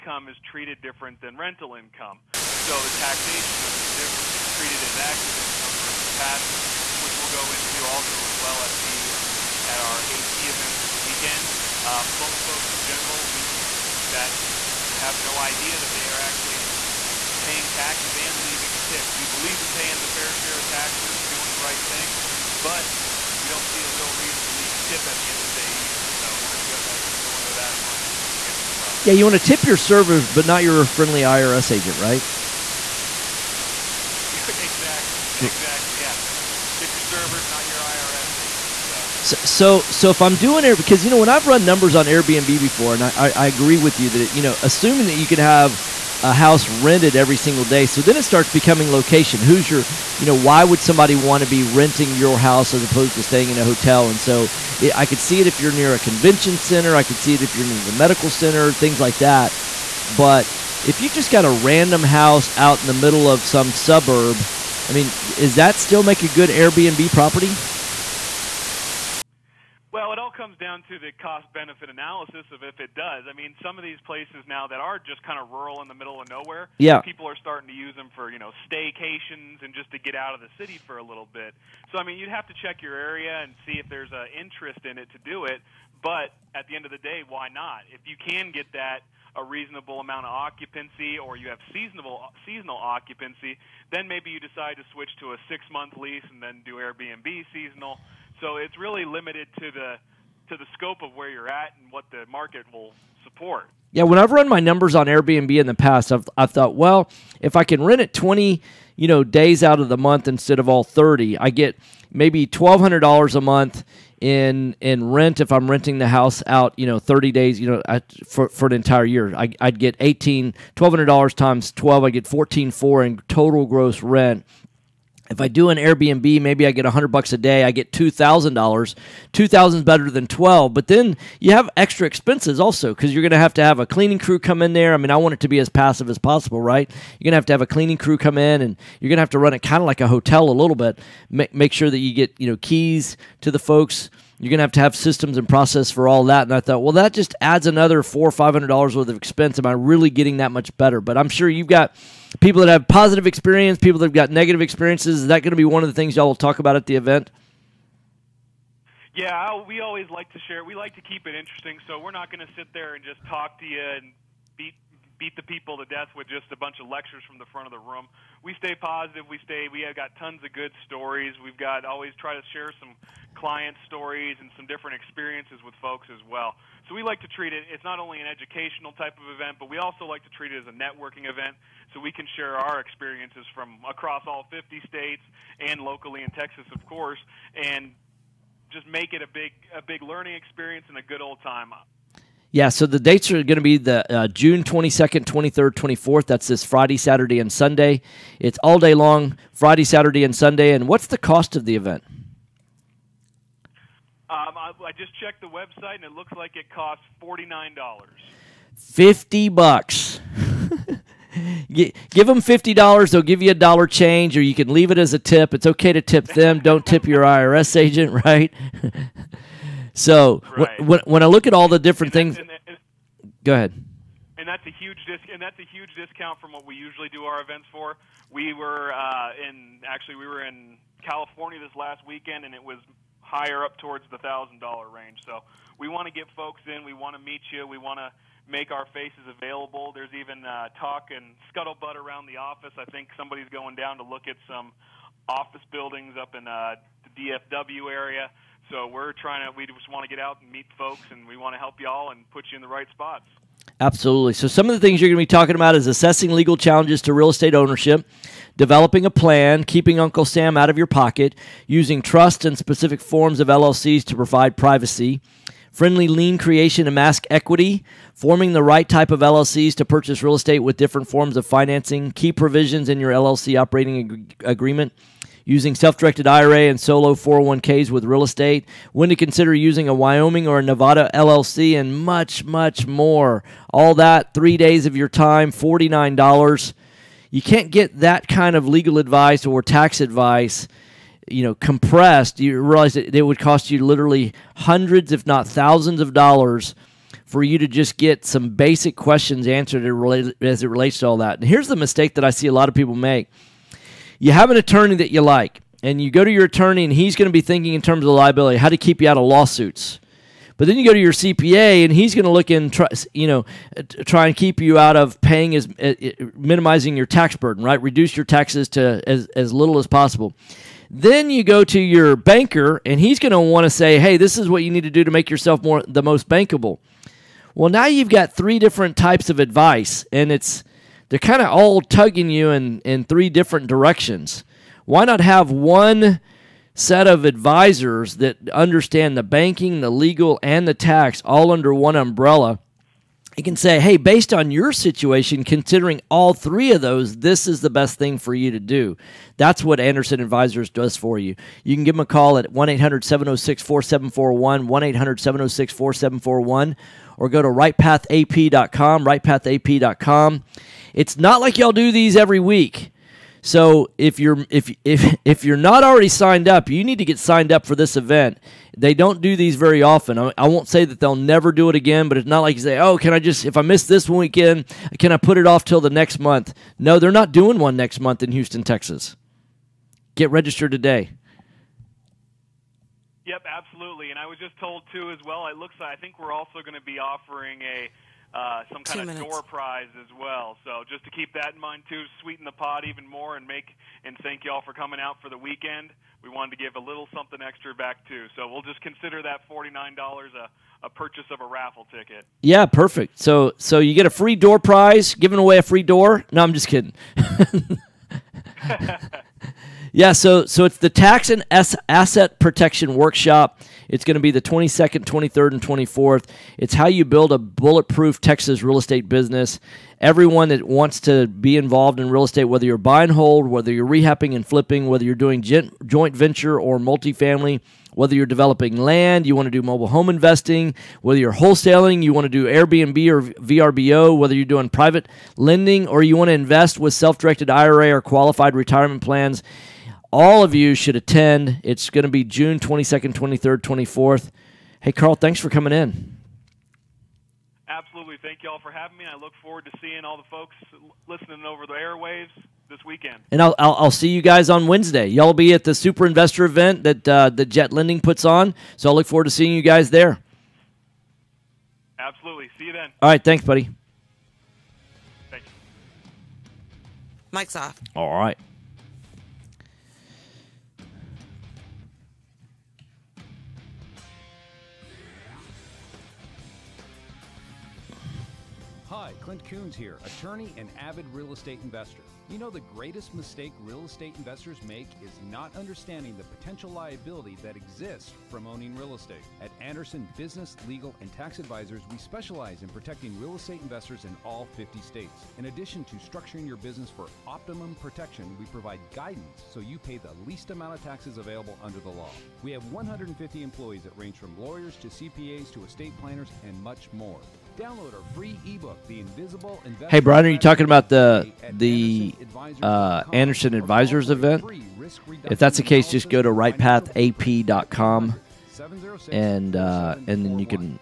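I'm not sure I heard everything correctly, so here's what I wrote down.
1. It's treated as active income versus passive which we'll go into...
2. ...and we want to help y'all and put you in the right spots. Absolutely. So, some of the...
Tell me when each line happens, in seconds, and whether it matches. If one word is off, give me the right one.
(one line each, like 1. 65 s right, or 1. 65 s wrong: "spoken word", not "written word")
1. 4 s right
2. 251 s right.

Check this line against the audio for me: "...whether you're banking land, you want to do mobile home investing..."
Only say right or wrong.
wrong.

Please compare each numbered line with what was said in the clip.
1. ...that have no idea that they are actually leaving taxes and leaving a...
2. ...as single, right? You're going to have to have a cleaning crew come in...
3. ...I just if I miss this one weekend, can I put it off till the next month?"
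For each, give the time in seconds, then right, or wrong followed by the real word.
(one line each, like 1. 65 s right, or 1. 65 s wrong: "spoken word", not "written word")
1. 14 s wrong: "paying", not "leaving"
2. 136 s wrong: "possible", not "single"
3. 373 s right.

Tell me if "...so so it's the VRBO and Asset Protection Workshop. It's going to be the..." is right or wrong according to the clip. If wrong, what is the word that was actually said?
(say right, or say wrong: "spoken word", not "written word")
wrong: "Tax", not "VRBO".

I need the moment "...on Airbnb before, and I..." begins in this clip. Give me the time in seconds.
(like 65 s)
41 s.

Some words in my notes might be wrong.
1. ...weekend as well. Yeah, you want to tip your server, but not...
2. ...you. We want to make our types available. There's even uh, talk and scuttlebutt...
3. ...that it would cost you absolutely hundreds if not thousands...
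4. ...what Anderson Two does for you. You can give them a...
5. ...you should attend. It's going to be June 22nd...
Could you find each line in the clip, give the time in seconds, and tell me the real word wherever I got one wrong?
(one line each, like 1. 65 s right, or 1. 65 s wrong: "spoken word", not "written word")
1. 28 s right
2. 237 s wrong: "faces", not "types"
3. 292 s wrong: "literally", not "absolutely"
4. 349 s wrong: "Advisors", not "Two"
5. 440 s right.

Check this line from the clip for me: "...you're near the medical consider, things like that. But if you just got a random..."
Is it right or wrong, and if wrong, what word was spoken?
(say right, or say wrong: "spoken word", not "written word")
wrong: "center", not "consider".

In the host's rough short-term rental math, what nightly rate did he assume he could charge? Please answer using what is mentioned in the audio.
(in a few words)
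$100.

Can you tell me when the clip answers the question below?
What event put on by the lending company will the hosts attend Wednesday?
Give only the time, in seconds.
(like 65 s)
455 s.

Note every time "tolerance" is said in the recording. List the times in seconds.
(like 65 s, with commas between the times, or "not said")
not said.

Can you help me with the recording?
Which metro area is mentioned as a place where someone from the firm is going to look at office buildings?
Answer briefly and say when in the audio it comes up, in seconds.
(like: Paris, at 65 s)
DFW, at 247 s.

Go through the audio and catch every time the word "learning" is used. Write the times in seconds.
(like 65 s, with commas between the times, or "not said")
190 s.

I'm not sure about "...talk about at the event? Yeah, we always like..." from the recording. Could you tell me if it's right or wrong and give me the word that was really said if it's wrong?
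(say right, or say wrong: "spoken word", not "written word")
right.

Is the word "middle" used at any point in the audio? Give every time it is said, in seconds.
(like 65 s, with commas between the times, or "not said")
62 s, 75 s.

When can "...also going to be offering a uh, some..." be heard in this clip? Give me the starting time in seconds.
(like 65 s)
386 s.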